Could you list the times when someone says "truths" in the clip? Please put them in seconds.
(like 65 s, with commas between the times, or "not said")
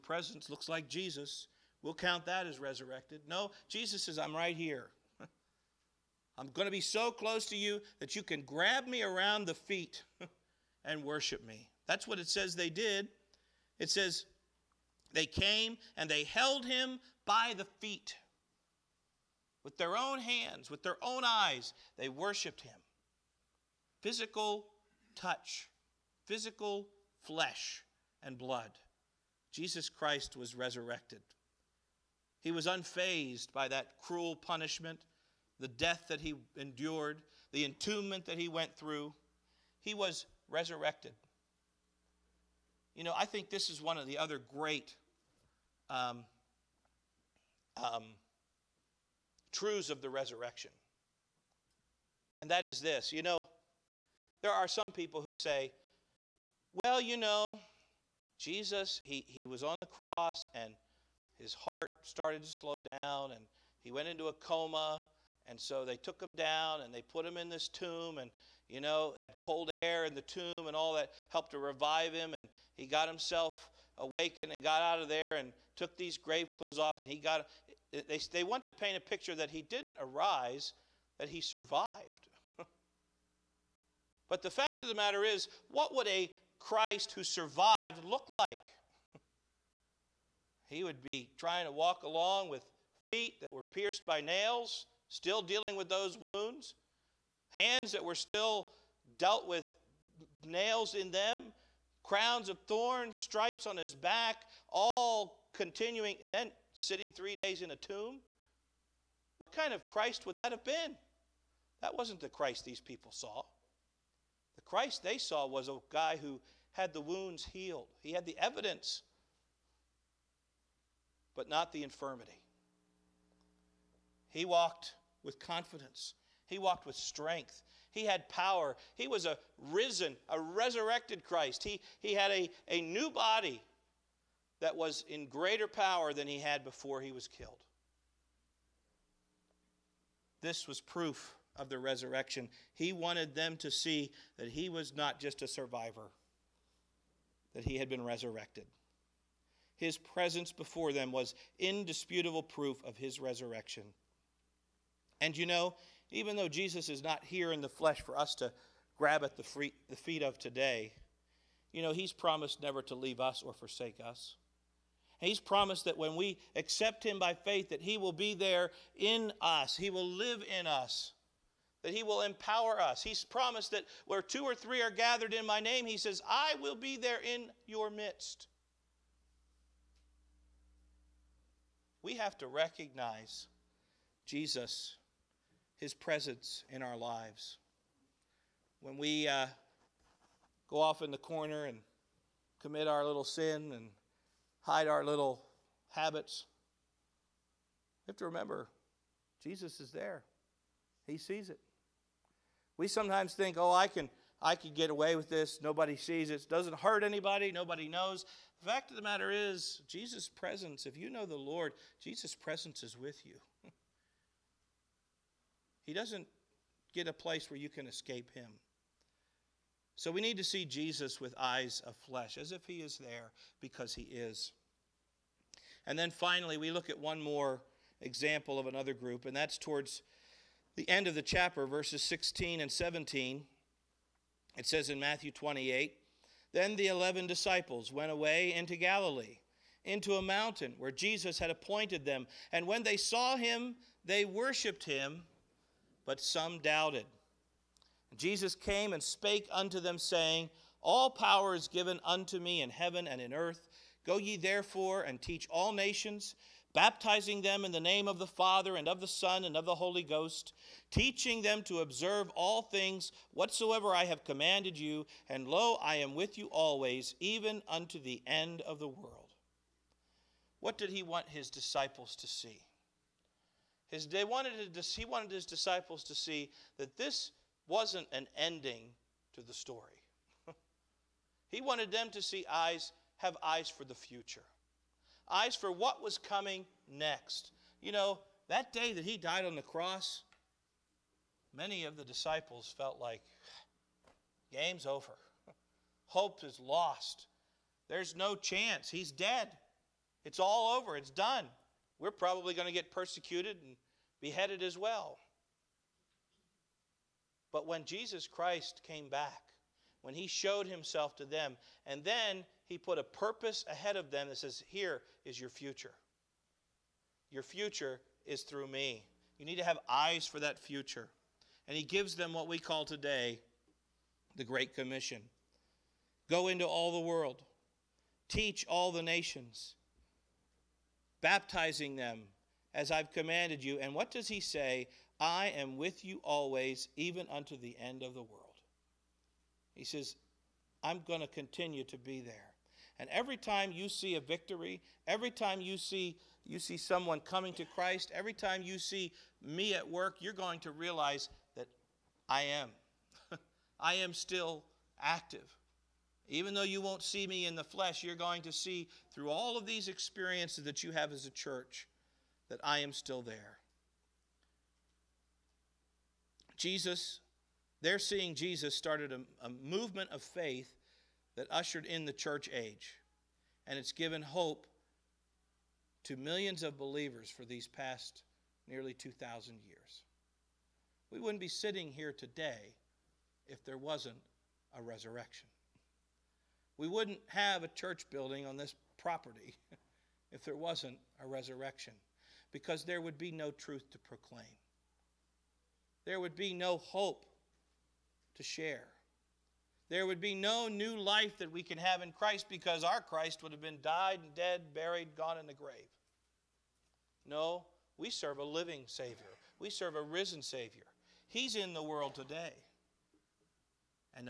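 49 s, 393 s.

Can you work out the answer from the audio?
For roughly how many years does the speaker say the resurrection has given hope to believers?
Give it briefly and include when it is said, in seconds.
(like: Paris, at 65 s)
Nearly 2,000 years, at 378 s.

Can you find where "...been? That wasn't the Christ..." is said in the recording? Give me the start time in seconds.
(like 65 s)
110 s.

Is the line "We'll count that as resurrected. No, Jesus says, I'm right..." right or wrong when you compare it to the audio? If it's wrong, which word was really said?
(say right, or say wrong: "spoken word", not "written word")
right.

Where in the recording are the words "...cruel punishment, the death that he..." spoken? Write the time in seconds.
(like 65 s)
34 s.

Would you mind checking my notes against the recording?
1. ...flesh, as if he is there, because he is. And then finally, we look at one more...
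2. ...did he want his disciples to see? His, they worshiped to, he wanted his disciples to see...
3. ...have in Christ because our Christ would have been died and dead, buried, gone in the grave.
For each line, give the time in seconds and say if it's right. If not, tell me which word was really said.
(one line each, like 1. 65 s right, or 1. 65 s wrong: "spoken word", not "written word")
1. 221 s right
2. 270 s wrong: "wanted", not "worshiped"
3. 401 s right.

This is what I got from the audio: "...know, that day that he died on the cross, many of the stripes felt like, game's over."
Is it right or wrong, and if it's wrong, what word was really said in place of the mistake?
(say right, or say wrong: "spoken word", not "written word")
wrong: "disciples", not "stripes".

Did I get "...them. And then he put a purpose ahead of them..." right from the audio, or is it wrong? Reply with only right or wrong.
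right.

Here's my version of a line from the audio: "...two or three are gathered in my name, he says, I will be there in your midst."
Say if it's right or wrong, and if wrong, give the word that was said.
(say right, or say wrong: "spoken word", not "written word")
right.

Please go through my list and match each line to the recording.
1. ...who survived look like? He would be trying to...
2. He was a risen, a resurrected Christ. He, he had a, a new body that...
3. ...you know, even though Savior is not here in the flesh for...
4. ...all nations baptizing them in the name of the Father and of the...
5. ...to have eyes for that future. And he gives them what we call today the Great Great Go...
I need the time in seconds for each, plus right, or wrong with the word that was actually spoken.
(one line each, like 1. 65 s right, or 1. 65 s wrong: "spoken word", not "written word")
1. 87 s right
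2. 128 s right
3. 155 s wrong: "Jesus", not "Savior"
4. 255 s right
5. 319 s wrong: "Commission", not "Great".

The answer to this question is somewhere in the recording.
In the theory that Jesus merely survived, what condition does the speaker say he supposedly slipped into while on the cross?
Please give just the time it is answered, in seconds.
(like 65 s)
64 s.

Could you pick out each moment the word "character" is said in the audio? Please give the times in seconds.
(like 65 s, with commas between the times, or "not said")
not said.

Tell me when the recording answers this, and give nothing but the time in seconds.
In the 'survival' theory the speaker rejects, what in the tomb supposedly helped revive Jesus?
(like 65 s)
69 s.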